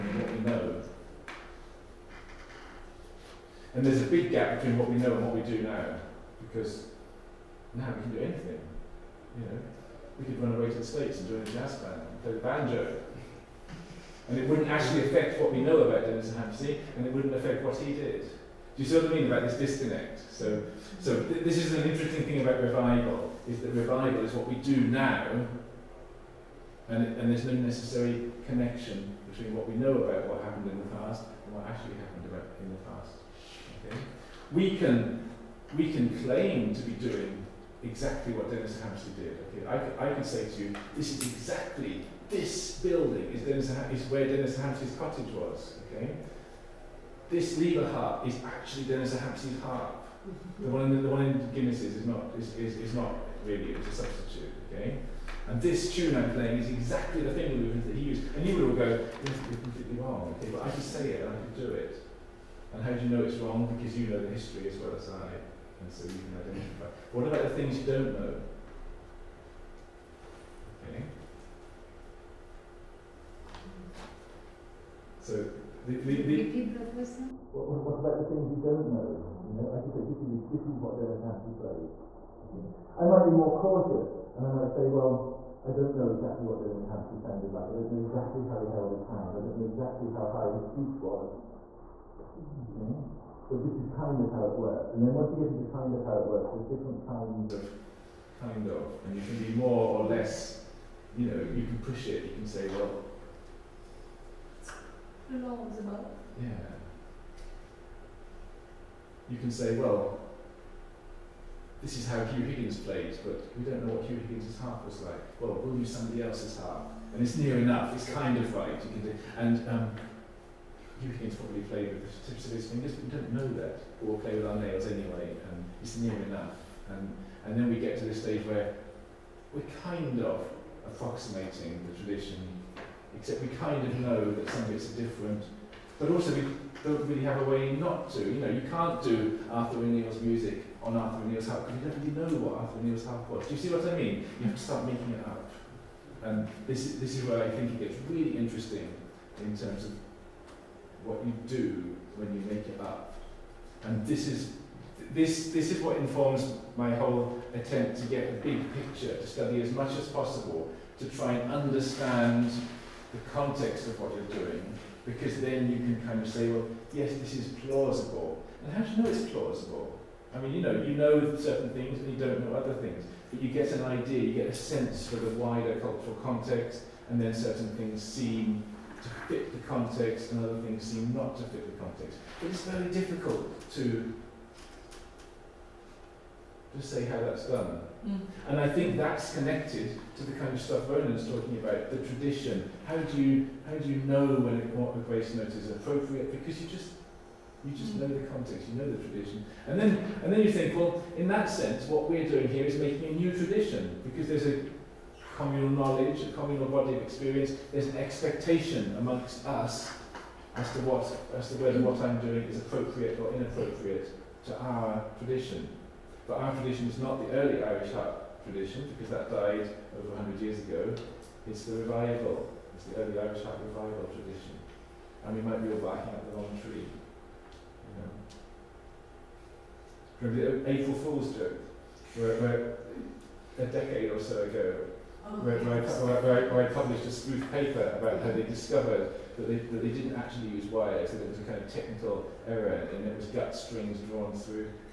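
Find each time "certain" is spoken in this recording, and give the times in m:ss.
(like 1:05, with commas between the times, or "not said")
2:51, 2:57.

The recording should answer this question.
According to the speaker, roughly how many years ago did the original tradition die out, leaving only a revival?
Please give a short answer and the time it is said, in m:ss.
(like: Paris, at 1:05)
over 100 years, at 3:39.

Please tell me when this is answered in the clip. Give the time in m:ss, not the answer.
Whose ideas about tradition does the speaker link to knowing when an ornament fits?
3:10.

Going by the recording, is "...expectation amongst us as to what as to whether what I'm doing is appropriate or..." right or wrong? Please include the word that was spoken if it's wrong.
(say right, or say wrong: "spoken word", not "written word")
right.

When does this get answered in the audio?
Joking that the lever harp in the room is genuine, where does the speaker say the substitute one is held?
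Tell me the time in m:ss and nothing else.
0:51.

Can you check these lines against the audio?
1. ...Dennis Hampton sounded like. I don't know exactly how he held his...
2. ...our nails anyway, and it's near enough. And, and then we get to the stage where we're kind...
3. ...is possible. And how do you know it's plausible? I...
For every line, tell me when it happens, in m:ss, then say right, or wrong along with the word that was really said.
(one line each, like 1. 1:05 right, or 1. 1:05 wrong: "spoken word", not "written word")
1. 1:26 right
2. 2:04 right
3. 2:47 wrong: "plausible", not "possible".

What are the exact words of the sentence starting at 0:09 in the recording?
You know, we could run away to the States and join a jazz band and play the banjo.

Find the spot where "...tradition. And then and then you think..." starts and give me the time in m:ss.
3:19.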